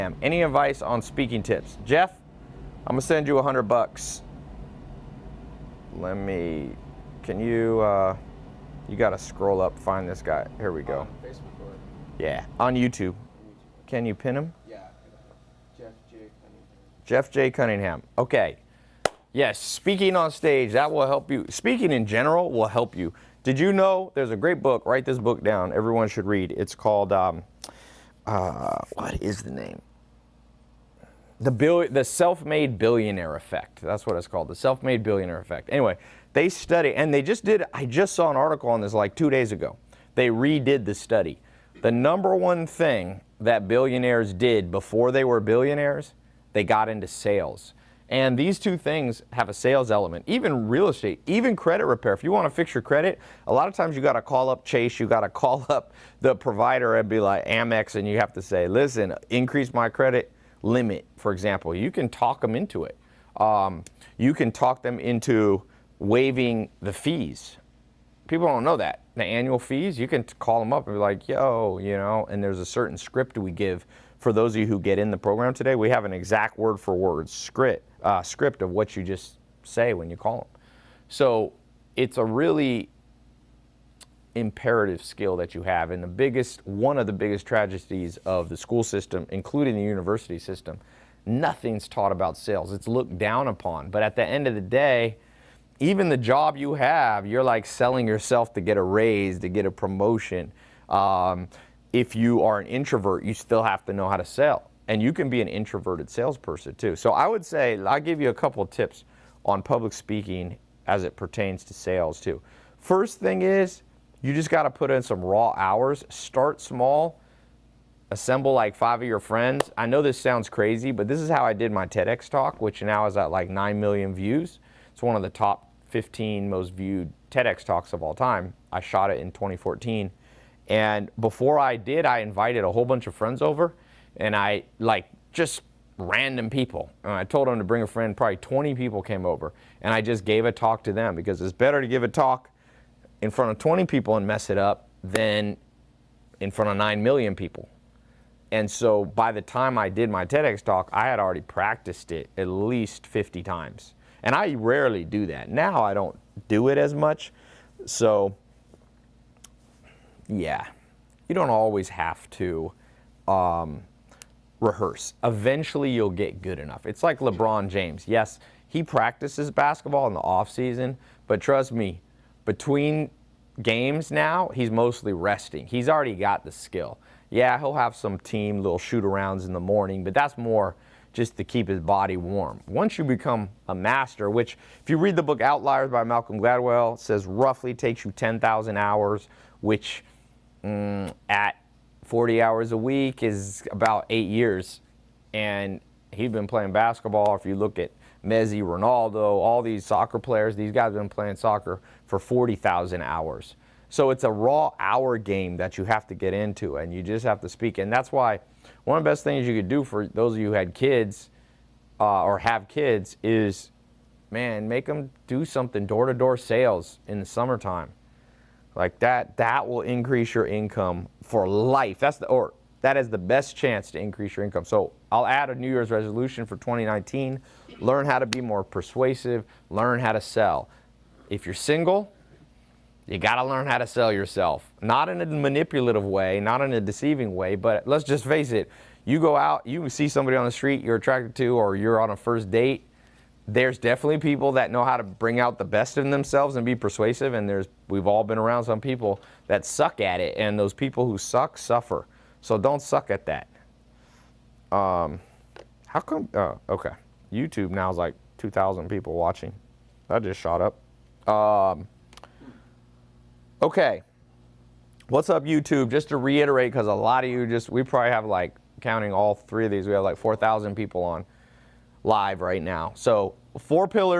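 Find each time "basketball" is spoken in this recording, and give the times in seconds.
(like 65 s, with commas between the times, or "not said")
169 s, 196 s.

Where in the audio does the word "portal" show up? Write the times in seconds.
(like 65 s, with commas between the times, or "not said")
not said.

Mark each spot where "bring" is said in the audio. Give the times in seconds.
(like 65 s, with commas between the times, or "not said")
137 s, 245 s.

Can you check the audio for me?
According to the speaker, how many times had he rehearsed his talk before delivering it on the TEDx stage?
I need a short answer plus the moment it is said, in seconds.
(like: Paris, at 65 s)
at least 50, at 152 s.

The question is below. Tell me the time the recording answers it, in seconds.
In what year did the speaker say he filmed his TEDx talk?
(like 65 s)
129 s.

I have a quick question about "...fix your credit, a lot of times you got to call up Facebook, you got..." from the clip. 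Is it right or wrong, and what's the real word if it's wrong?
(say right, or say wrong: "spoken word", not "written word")
wrong: "Chase", not "Facebook".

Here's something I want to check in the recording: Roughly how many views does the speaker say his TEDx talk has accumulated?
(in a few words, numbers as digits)
9 million.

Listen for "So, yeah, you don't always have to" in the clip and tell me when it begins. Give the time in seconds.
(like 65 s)
157 s.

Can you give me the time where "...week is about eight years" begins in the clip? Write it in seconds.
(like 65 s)
192 s.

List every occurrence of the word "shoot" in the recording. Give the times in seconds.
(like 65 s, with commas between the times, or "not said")
178 s.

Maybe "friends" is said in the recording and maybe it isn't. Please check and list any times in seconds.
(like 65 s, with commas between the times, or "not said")
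119 s, 133 s, 137 s.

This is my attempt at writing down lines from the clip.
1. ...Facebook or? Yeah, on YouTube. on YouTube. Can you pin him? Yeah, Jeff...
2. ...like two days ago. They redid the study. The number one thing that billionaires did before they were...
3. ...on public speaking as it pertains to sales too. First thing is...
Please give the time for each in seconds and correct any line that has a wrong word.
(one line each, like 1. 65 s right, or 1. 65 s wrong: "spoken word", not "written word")
1. 11 s right
2. 38 s right
3. 109 s right.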